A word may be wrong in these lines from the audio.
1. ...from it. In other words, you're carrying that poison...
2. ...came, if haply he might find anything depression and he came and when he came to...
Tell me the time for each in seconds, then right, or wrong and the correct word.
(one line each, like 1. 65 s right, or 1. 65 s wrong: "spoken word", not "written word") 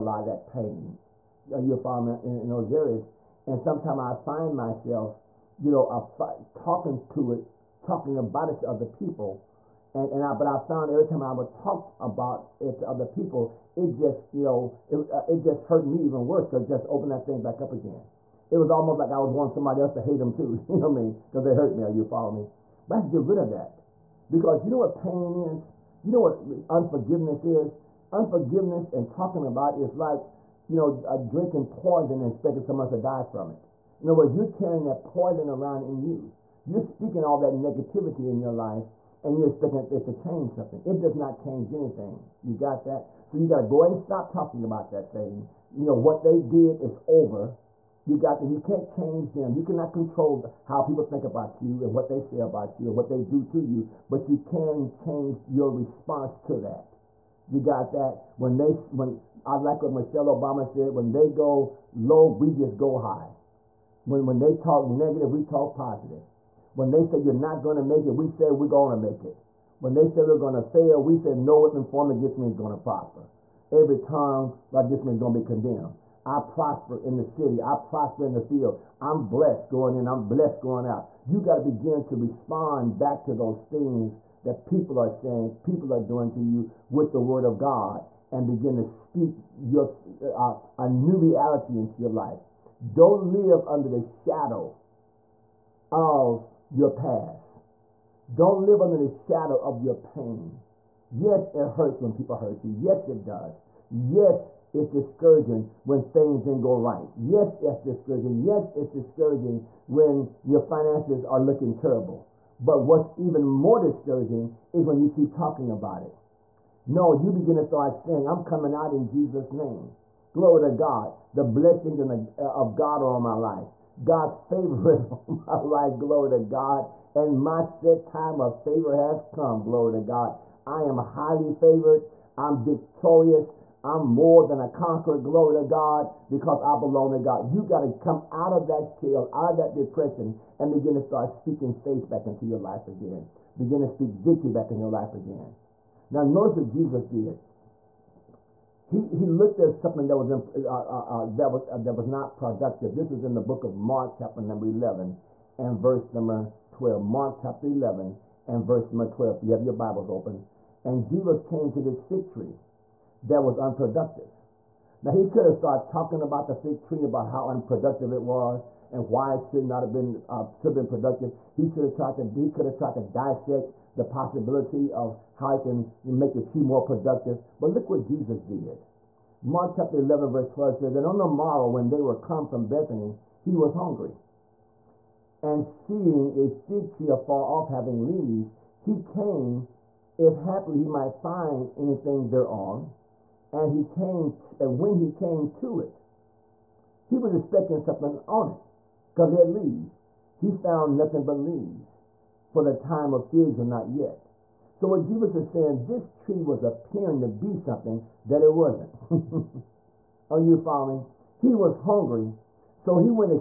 1. 33 s right
2. 189 s wrong: "thereon", not "depression".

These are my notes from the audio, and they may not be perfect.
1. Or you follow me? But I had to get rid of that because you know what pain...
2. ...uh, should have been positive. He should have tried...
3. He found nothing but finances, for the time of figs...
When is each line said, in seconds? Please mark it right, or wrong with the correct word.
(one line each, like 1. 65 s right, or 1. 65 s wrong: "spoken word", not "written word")
1. 21 s right
2. 170 s wrong: "productive", not "positive"
3. 200 s wrong: "leaves", not "finances".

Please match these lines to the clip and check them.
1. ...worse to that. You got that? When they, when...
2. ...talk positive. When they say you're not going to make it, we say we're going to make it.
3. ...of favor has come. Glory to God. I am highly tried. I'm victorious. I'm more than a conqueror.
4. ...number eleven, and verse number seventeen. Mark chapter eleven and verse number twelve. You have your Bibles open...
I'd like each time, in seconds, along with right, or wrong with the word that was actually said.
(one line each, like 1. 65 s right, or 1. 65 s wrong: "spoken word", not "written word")
1. 55 s wrong: "response", not "worse"
2. 65 s right
3. 128 s wrong: "favored", not "tried"
4. 154 s wrong: "twelve", not "seventeen".